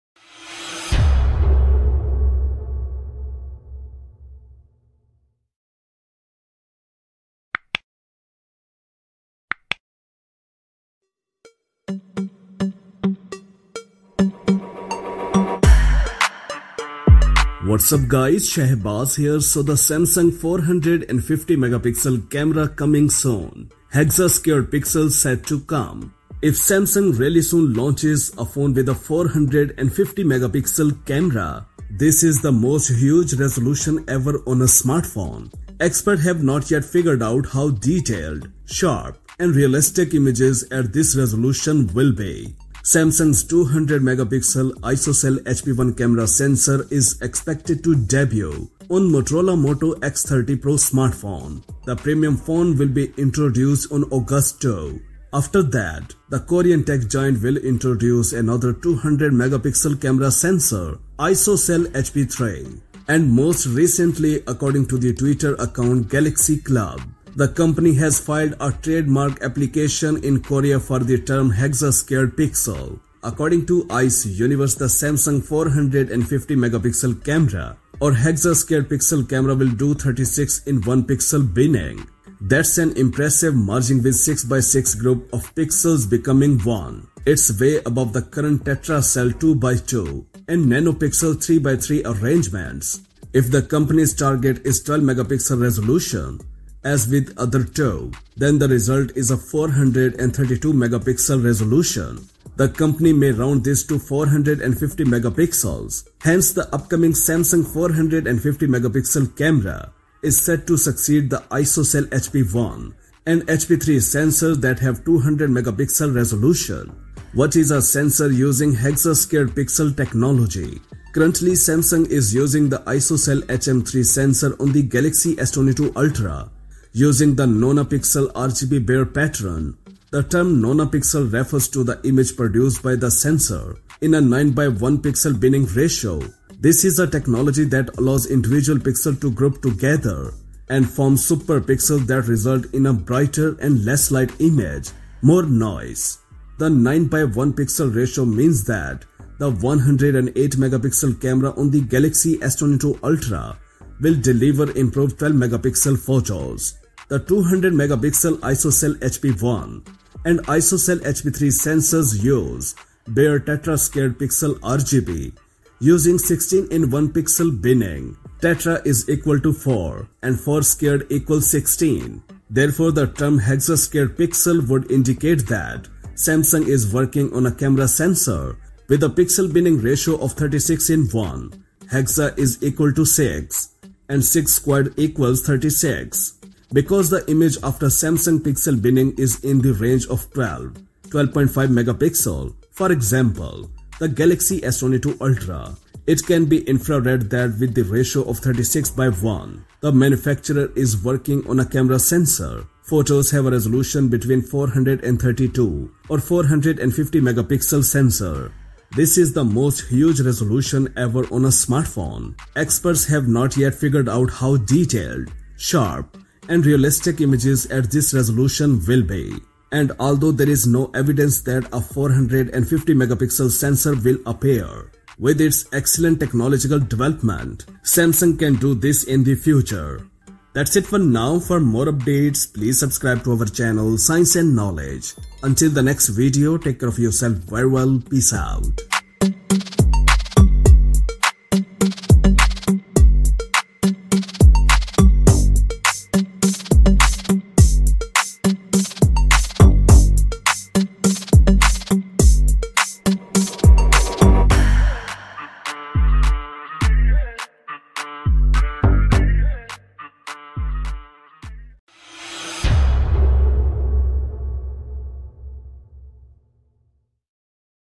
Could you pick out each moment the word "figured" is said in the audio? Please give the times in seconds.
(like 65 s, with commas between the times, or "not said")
36 s, 213 s.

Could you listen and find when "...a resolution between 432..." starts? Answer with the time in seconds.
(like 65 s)
203 s.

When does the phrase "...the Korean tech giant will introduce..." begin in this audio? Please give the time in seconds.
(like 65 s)
56 s.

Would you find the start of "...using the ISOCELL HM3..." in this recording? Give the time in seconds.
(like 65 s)
122 s.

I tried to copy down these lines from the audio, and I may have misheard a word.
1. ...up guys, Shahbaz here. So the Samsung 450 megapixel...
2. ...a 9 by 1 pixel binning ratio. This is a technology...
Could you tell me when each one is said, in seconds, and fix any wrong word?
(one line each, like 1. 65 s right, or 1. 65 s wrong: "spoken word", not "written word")
1. 17 s right
2. 134 s right.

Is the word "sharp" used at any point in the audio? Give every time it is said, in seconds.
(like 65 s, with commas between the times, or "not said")
38 s, 215 s.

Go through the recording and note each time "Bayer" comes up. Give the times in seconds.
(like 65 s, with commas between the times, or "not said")
128 s, 163 s.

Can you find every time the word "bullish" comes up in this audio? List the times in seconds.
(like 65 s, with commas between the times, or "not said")
not said.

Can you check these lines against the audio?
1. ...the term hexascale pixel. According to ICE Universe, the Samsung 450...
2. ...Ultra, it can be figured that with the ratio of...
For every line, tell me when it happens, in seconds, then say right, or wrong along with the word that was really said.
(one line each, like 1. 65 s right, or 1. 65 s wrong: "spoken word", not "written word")
1. 70 s right
2. 195 s wrong: "infrared", not "figured".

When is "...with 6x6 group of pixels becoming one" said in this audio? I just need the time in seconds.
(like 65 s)
84 s.